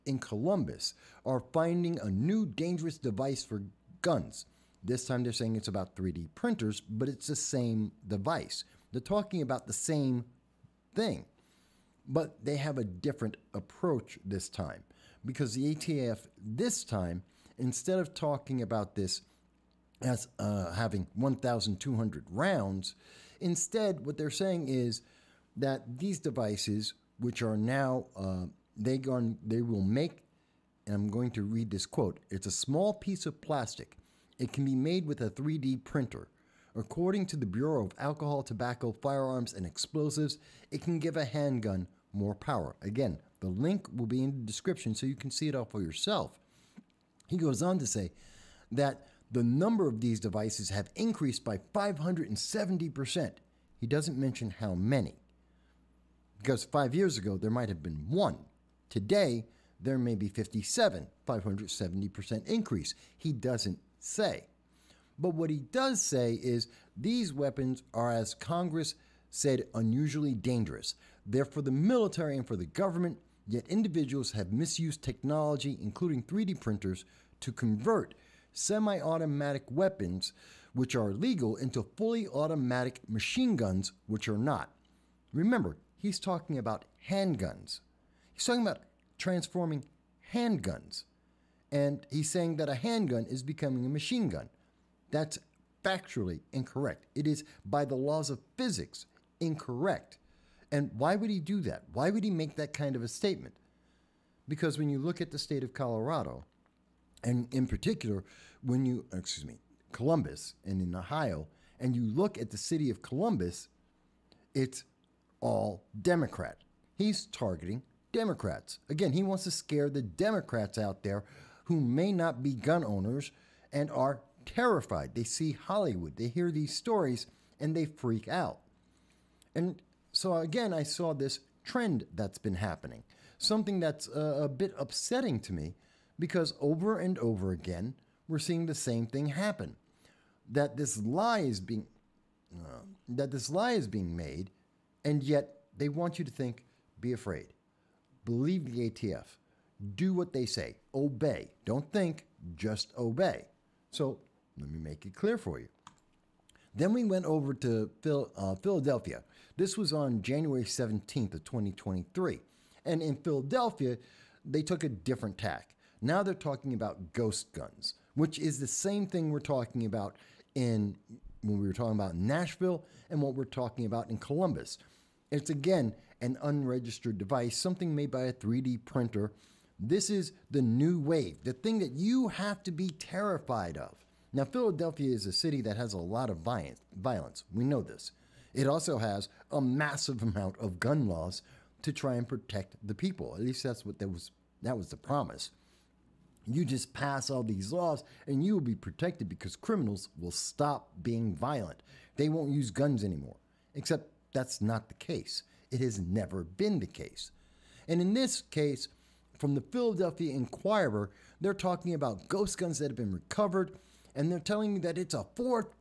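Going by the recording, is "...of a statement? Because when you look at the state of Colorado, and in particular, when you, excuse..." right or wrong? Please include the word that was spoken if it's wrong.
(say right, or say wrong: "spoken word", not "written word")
right.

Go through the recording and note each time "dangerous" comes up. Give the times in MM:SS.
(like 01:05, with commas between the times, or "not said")
00:02, 01:10.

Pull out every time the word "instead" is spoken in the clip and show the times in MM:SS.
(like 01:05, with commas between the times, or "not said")
00:17, 00:23.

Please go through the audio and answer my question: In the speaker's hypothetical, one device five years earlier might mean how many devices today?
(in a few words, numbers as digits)
57.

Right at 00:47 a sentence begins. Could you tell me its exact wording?
He goes on to say that the number of these devices have increased by 570%.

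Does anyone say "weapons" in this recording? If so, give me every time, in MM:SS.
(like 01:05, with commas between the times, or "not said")
01:07, 01:19.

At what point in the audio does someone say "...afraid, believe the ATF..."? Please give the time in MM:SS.
02:27.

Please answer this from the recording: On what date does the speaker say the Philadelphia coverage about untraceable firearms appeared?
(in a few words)
January 17, 2023.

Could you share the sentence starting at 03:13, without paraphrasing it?
At least that's what that was that was the promise.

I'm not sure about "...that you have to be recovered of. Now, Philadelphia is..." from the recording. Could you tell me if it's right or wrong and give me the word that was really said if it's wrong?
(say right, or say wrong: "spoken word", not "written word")
wrong: "terrified", not "recovered".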